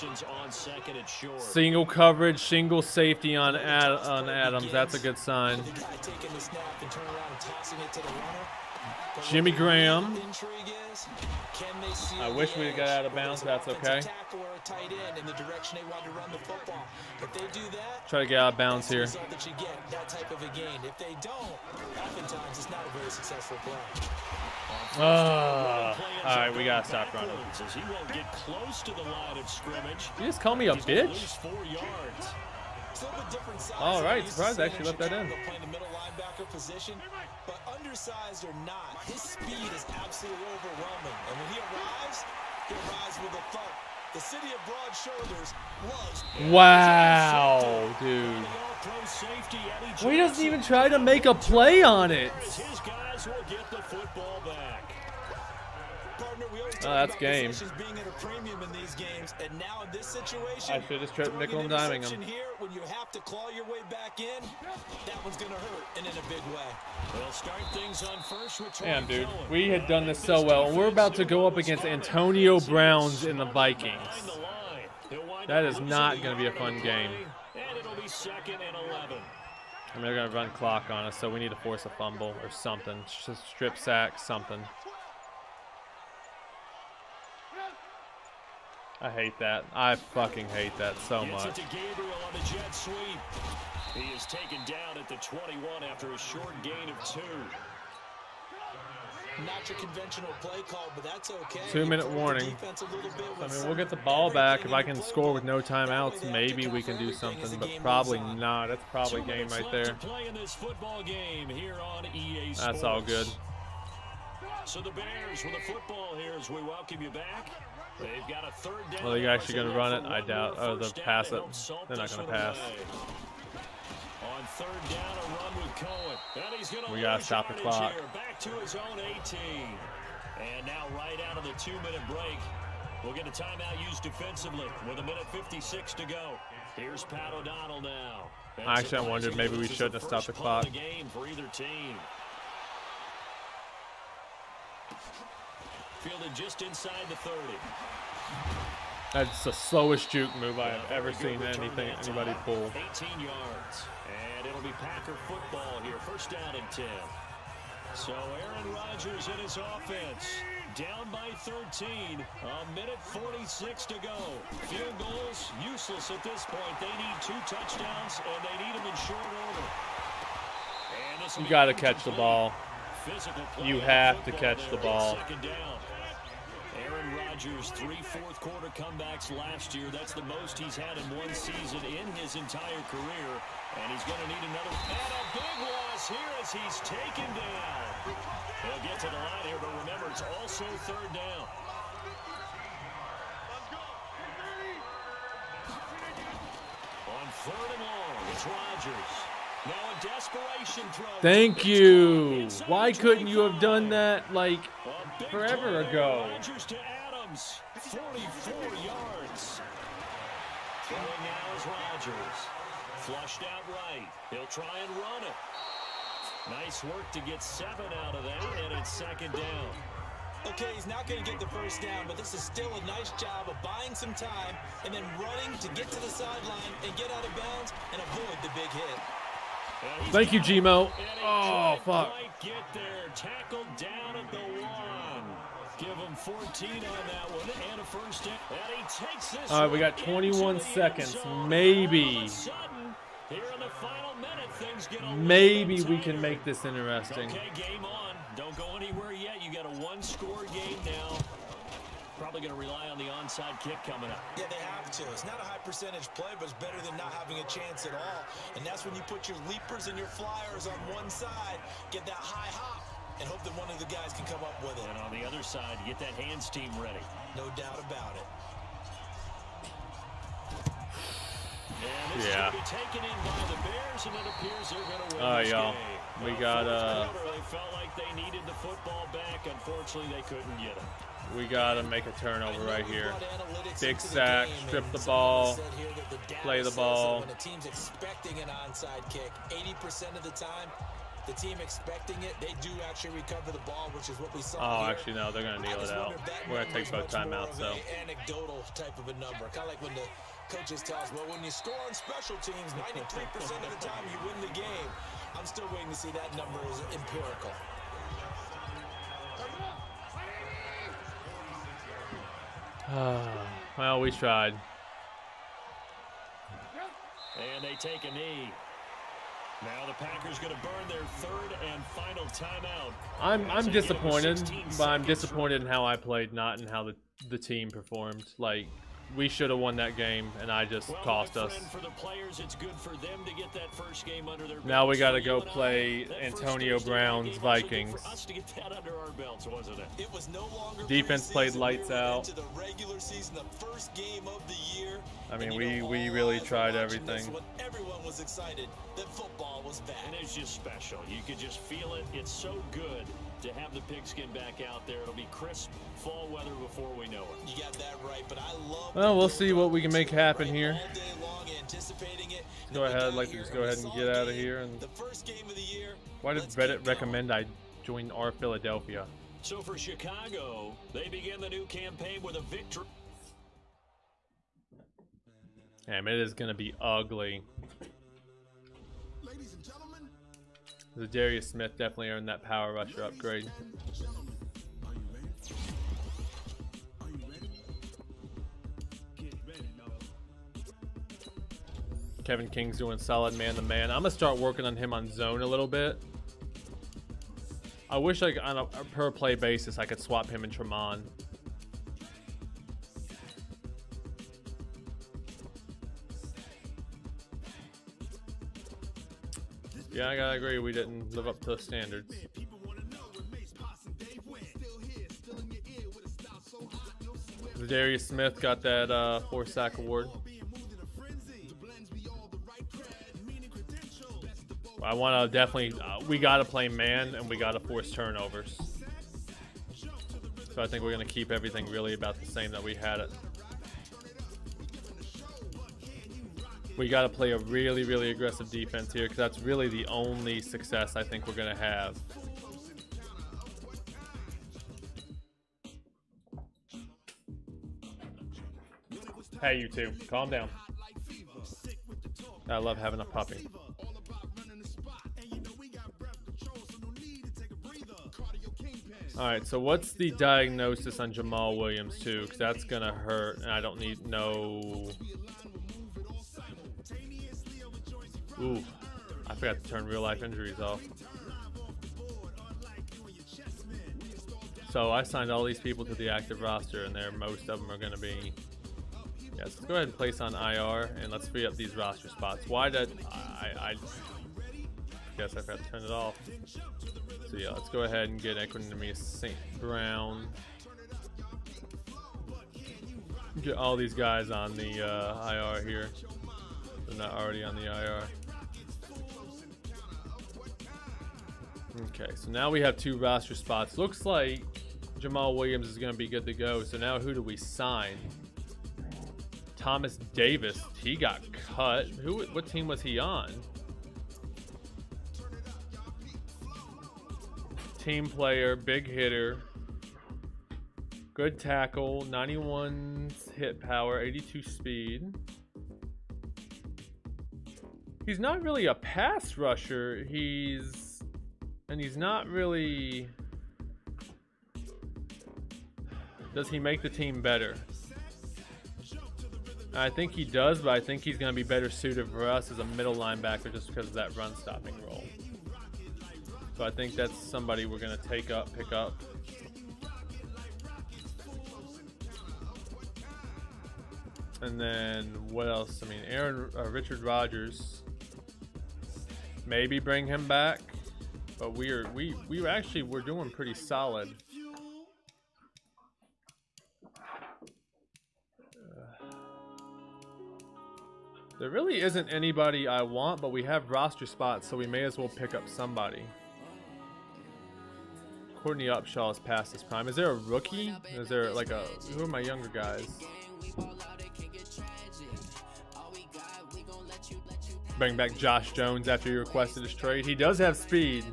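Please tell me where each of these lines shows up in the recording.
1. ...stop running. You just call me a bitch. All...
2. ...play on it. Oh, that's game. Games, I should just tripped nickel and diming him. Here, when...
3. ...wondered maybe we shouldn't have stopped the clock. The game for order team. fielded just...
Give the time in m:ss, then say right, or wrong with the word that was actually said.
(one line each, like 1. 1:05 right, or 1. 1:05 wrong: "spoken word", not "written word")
1. 0:26 right
2. 0:51 right
3. 2:19 wrong: "either", not "order".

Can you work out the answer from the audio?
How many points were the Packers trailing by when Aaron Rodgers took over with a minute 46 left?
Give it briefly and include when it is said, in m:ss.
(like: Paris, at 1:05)
13, at 2:41.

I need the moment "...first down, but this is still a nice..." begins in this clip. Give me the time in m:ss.
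3:41.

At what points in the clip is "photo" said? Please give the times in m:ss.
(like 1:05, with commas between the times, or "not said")
not said.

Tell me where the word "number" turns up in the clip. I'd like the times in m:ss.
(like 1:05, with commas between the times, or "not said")
4:59, 5:06.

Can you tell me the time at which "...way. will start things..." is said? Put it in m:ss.
1:06.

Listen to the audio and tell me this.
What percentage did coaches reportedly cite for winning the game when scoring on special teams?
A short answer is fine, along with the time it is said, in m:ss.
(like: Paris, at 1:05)
93%, at 5:02.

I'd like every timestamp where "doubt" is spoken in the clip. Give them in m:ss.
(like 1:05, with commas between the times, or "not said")
2:00, 4:27.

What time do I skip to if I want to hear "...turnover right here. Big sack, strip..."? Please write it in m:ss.
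4:42.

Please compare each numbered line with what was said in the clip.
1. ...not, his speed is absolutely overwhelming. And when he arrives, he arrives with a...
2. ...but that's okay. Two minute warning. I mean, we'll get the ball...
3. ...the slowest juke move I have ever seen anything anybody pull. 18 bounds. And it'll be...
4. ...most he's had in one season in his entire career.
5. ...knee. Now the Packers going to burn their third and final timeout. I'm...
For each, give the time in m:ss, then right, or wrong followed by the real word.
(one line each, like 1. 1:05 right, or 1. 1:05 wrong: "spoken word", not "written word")
1. 0:38 right
2. 1:40 right
3. 2:29 wrong: "yards", not "bounds"
4. 3:00 right
5. 5:18 right.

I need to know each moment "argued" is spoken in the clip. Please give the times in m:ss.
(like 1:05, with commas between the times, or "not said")
not said.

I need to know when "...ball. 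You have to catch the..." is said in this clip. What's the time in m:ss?
2:52.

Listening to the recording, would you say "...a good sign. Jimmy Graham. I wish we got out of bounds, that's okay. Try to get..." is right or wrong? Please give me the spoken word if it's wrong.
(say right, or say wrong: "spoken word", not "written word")
right.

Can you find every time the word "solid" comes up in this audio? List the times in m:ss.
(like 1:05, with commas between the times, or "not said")
6:32, 9:23.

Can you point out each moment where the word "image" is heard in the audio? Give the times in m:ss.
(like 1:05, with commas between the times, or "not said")
not said.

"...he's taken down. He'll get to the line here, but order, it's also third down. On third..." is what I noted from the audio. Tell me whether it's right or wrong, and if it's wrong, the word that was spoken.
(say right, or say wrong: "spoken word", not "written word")
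wrong: "remember", not "order".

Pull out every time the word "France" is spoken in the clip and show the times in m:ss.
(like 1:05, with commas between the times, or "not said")
not said.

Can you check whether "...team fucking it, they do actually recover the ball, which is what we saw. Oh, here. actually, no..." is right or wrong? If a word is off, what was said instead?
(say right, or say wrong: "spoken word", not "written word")
wrong: "expecting", not "fucking".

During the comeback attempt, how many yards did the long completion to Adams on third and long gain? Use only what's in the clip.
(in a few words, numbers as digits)
44 yards.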